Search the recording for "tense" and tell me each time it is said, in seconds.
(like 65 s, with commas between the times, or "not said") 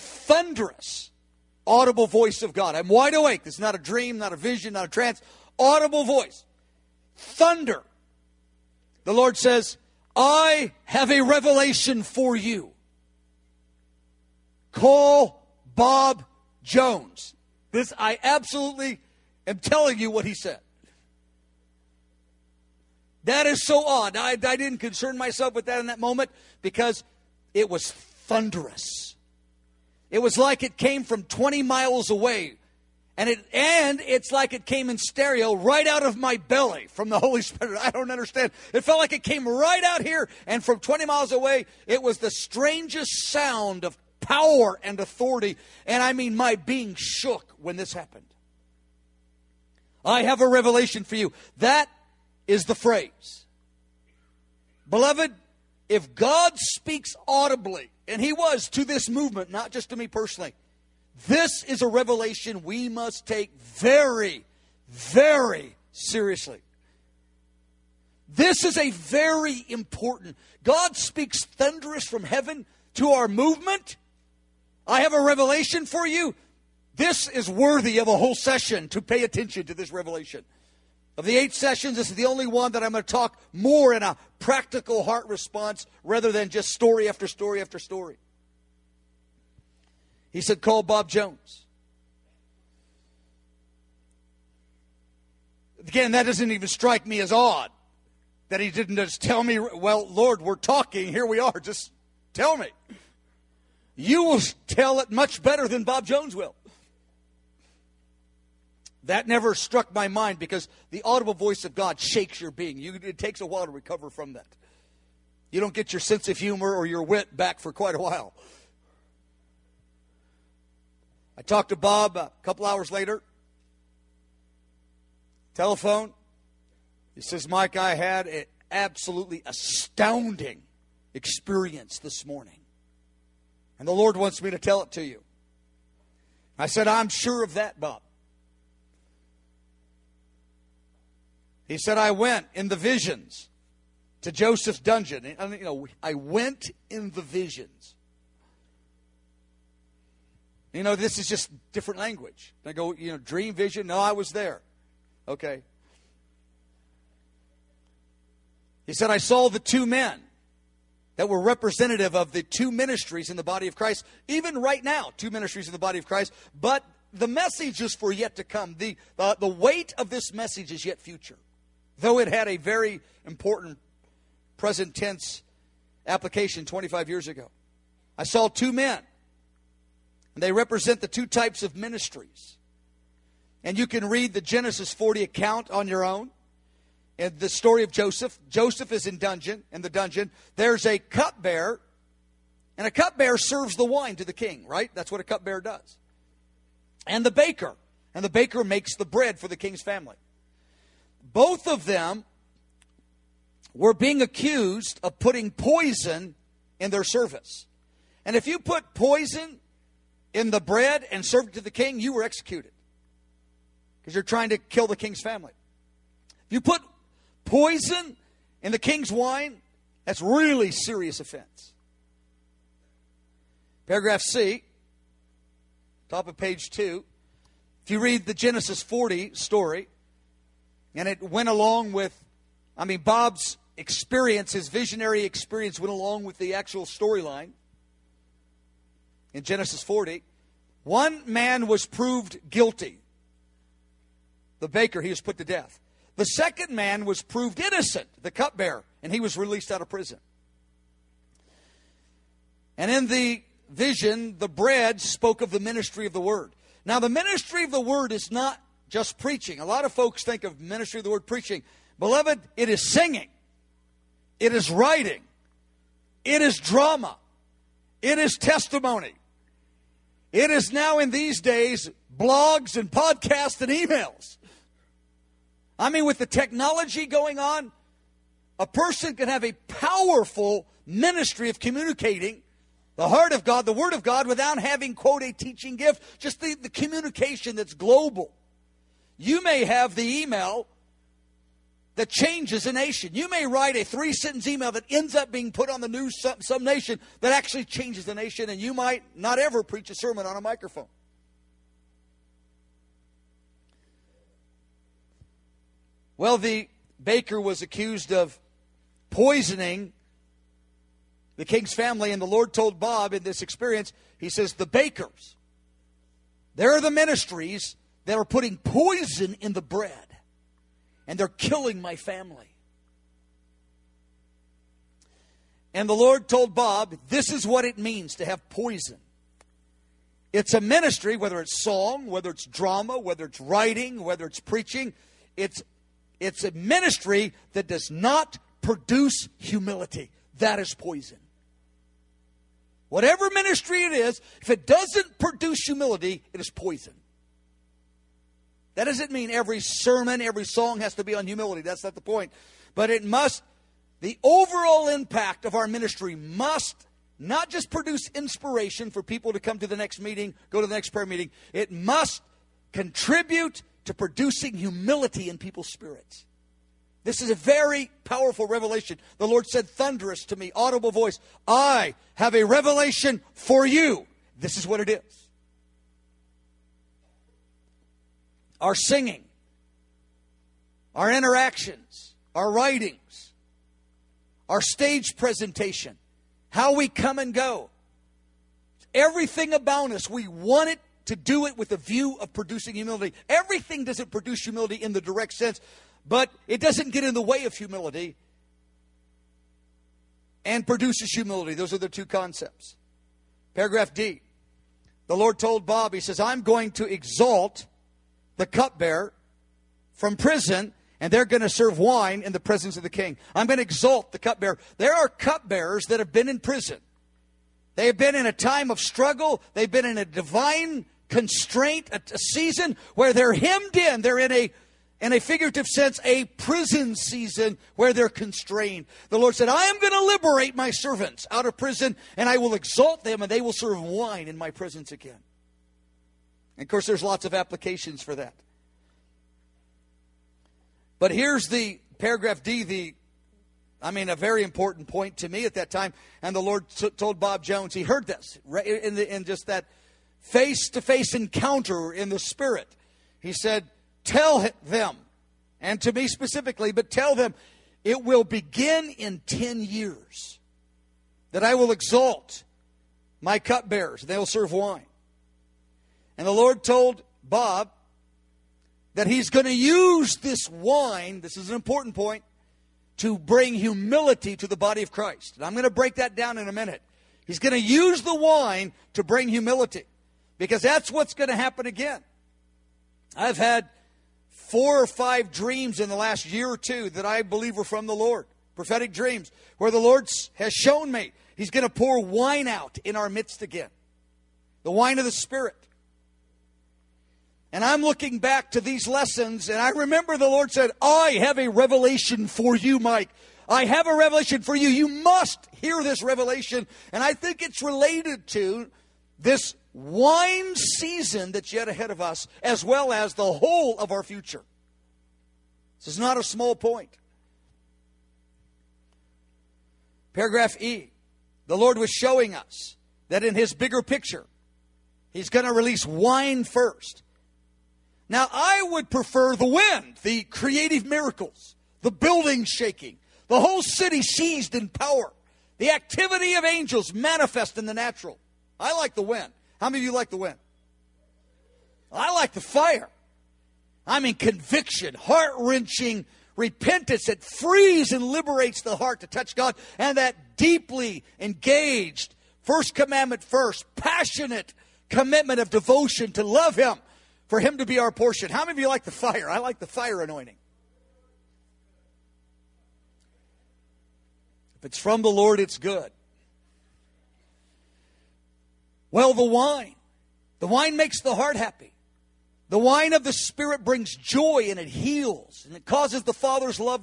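174 s.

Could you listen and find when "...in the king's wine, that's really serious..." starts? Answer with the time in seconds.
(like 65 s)
218 s.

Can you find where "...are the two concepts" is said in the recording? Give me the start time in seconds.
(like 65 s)
401 s.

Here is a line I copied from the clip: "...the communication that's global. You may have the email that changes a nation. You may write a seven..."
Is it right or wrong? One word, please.
wrong.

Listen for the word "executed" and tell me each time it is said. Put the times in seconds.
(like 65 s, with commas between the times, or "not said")
212 s.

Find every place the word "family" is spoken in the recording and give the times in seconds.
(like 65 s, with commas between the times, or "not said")
199 s, 215 s, 311 s, 321 s.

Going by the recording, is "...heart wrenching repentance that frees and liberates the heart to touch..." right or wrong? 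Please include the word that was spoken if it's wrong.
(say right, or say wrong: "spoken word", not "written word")
right.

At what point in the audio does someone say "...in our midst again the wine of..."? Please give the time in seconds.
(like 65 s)
492 s.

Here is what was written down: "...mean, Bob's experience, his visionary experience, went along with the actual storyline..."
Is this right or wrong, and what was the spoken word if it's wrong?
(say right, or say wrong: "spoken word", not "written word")
right.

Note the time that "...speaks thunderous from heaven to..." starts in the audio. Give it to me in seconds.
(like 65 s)
70 s.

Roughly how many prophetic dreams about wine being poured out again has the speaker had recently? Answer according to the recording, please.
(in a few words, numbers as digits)
Four or five.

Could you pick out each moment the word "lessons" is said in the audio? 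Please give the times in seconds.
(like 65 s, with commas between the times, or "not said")
498 s.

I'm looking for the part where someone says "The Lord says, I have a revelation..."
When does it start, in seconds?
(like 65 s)
9 s.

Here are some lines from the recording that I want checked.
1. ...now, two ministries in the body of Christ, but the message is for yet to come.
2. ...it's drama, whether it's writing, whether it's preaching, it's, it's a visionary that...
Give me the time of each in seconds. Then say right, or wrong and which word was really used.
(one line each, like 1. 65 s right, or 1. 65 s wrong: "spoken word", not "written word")
1. 164 s right
2. 332 s wrong: "ministry", not "visionary".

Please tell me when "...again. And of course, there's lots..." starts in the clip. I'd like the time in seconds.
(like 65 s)
434 s.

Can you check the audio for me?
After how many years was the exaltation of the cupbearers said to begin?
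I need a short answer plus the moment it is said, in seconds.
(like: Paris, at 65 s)
10 years, at 459 s.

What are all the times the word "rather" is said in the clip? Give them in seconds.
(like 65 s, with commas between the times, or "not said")
86 s.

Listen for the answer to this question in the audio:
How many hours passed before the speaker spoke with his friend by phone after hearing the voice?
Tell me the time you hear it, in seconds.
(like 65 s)
122 s.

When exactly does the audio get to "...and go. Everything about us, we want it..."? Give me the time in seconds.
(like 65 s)
387 s.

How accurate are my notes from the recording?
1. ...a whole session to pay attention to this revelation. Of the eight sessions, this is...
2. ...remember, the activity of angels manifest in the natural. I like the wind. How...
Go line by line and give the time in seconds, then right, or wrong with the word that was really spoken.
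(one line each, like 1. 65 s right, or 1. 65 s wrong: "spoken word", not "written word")
1. 78 s right
2. 534 s wrong: "power", not "remember".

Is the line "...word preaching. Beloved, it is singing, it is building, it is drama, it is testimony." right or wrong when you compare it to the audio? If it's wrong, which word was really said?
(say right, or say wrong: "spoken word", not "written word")
wrong: "writing", not "building".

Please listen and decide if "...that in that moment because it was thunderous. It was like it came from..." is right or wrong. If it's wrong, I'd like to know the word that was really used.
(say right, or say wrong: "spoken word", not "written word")
right.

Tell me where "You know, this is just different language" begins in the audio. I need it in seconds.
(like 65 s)
150 s.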